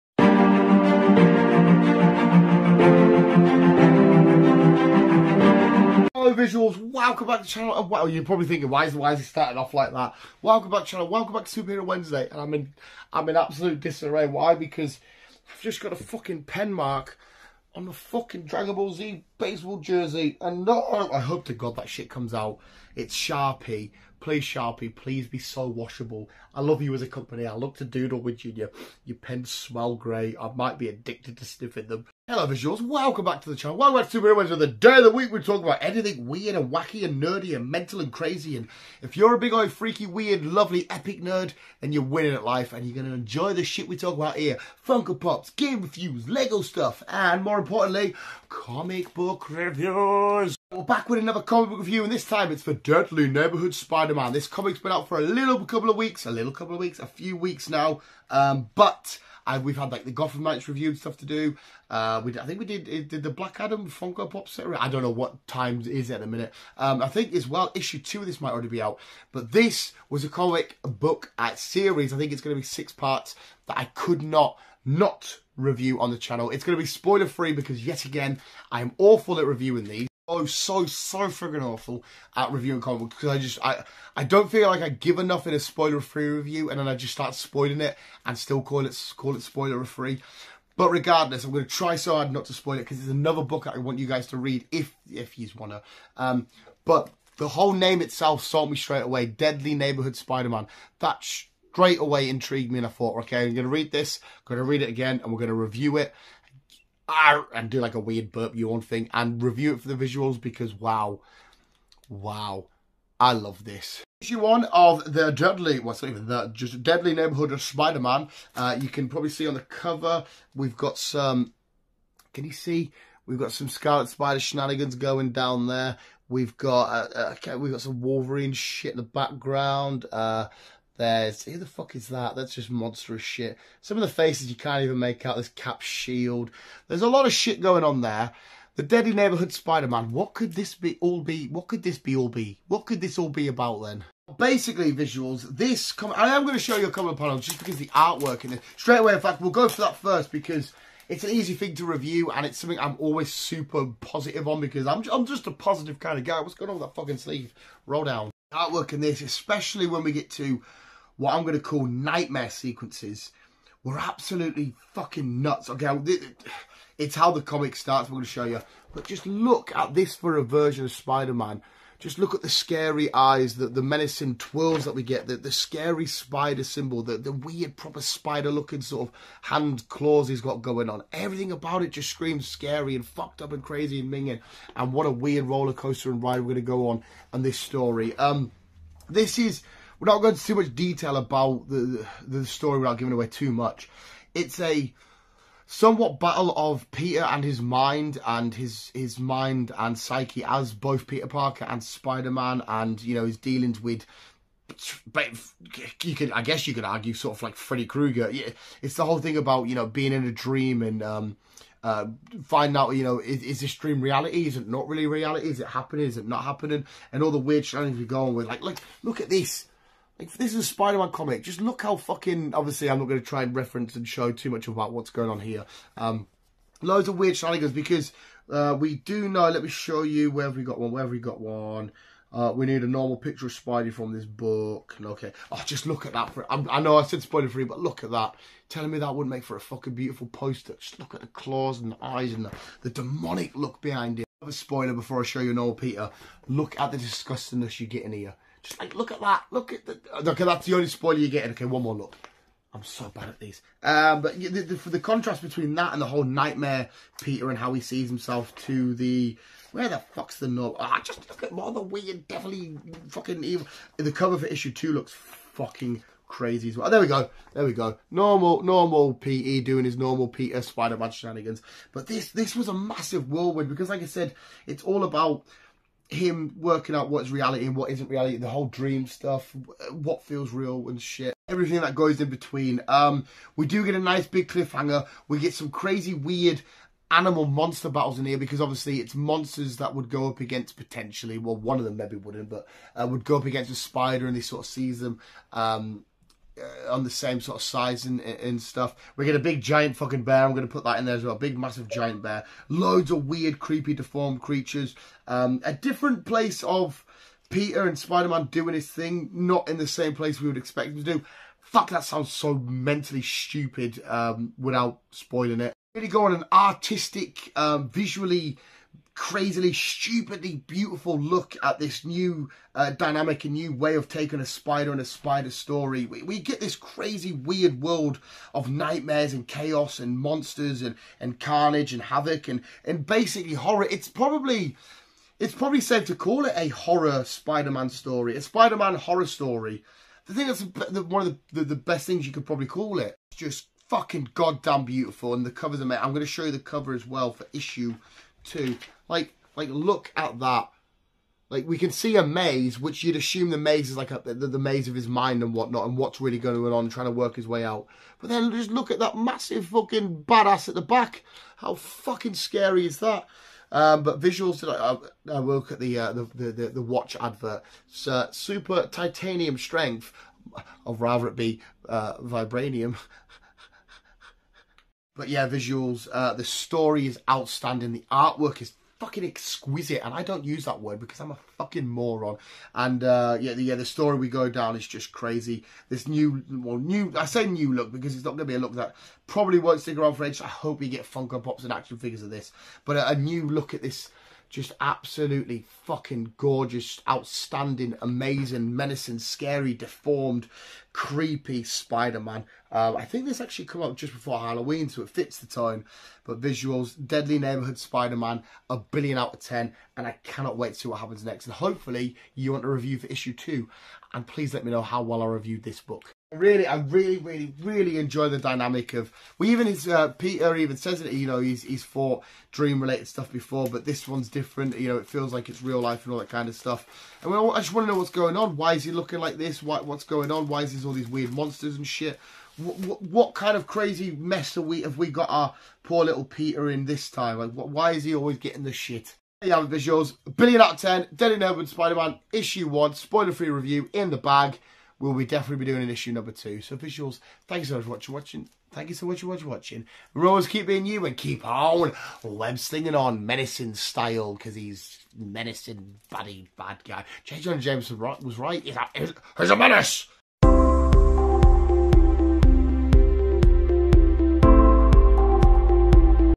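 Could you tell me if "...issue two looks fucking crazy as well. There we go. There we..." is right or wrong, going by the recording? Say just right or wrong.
right.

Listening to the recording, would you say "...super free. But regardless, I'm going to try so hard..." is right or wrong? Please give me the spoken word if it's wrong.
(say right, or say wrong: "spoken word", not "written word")
wrong: "spoiler", not "super".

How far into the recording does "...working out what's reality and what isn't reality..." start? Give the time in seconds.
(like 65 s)
276 s.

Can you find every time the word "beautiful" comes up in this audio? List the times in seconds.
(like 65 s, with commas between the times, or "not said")
239 s, 320 s, 344 s.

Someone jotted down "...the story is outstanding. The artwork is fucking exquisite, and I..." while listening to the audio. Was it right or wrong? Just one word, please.
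right.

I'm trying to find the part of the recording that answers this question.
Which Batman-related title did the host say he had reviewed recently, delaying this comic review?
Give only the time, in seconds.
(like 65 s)
60 s.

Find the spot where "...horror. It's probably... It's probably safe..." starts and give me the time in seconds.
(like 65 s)
333 s.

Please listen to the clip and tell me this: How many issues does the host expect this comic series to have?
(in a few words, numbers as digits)
6.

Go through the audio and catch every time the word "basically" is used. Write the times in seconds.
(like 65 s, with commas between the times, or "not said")
144 s, 333 s.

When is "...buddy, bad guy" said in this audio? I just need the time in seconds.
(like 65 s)
456 s.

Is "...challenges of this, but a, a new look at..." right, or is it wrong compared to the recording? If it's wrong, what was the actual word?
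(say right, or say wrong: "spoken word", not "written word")
wrong: "figures", not "challenges".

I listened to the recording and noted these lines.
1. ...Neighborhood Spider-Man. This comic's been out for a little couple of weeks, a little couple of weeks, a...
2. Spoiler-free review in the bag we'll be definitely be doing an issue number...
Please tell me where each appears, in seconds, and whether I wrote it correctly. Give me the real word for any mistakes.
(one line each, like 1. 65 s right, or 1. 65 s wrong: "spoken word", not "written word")
1. 53 s right
2. 442 s right.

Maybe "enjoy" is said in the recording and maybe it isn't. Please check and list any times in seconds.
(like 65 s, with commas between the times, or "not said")
43 s, 417 s.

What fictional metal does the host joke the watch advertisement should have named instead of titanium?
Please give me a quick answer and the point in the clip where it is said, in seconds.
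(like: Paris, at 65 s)
Vibranium, at 372 s.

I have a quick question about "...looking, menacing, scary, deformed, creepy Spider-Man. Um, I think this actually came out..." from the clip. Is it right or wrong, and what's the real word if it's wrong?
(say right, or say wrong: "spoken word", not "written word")
wrong: "amazing", not "looking".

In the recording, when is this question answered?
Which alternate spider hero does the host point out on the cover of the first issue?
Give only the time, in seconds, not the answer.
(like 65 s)
123 s.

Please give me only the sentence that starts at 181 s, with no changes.
Everything about it just screams scary and fucked up and crazy and minging.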